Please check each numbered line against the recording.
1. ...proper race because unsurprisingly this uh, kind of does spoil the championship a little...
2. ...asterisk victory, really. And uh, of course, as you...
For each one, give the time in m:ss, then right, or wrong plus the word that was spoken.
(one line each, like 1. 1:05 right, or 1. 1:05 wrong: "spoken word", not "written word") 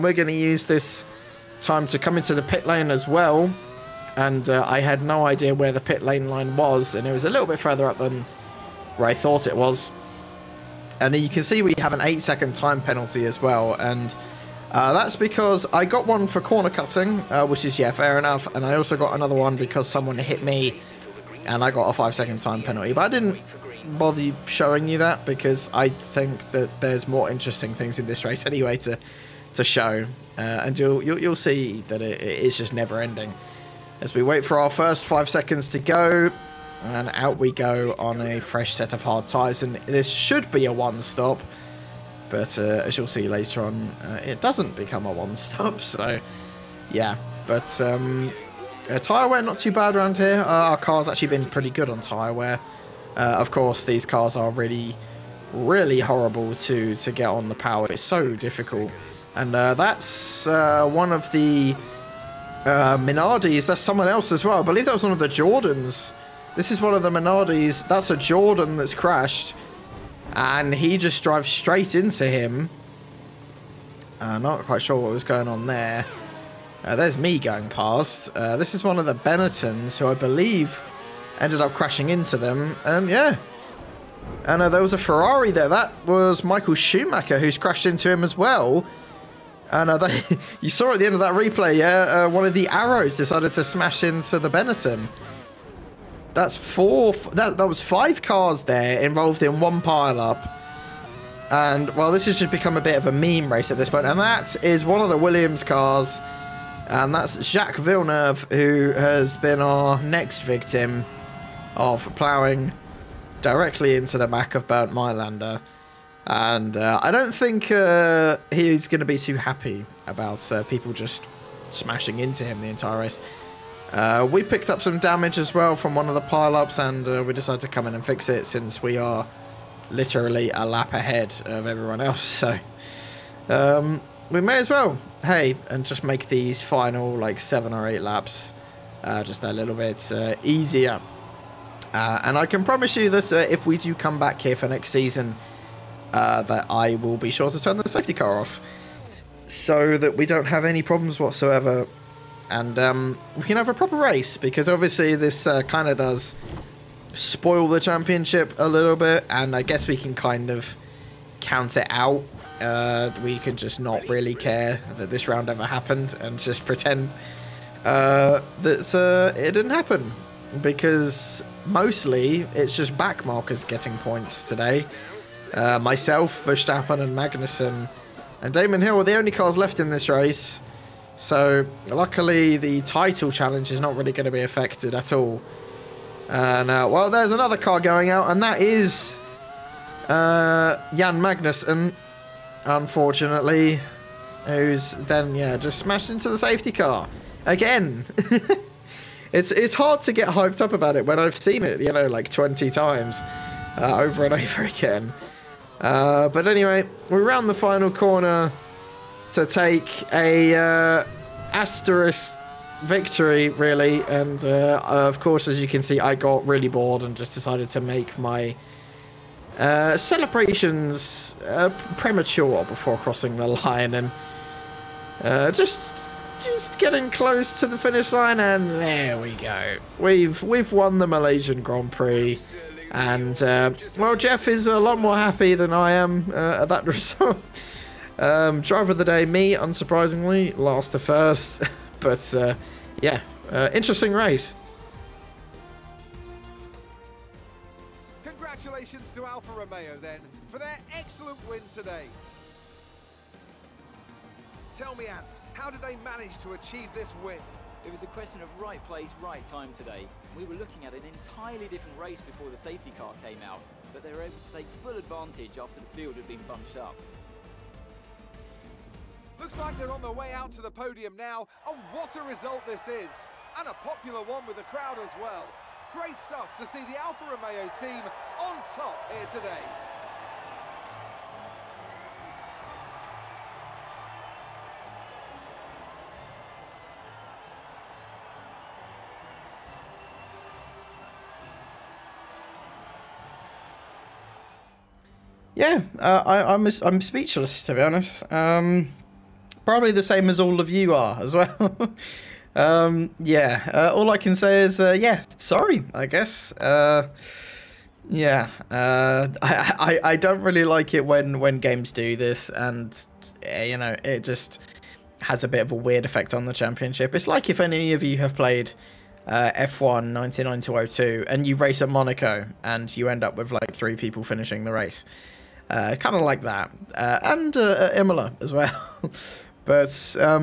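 1. 2:33 wrong: "obviously", not "unsurprisingly"
2. 3:31 right.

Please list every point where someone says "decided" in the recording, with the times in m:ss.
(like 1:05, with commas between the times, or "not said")
1:33, 2:07, 3:37.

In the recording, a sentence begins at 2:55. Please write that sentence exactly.
Uh, myself, Verstappen, and Magnussen, and Damon Hill are the only cars left in this race.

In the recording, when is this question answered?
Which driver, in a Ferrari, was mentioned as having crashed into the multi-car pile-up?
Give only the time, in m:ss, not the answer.
1:26.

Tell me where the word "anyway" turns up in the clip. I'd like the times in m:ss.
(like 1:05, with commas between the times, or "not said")
0:28, 3:26.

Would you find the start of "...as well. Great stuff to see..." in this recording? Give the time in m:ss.
4:35.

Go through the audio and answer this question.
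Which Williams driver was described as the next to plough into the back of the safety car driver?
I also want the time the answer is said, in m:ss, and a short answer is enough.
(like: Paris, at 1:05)
Jacques Villeneuve, at 1:47.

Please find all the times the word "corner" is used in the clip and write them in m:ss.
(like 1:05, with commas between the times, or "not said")
0:16, 3:27.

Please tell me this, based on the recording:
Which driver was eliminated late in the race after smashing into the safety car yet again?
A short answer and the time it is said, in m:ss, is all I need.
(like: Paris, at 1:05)
Jan Magnussen, at 3:10.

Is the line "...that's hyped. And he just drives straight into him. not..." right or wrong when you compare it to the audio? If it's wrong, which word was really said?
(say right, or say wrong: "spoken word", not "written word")
wrong: "crashed", not "hyped".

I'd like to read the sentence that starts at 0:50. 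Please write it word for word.
Uh, our car's actually been pretty good on tyre wear.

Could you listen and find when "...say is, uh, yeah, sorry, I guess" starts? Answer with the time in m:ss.
5:04.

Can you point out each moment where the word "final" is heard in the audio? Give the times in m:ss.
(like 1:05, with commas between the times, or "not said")
2:16, 3:27.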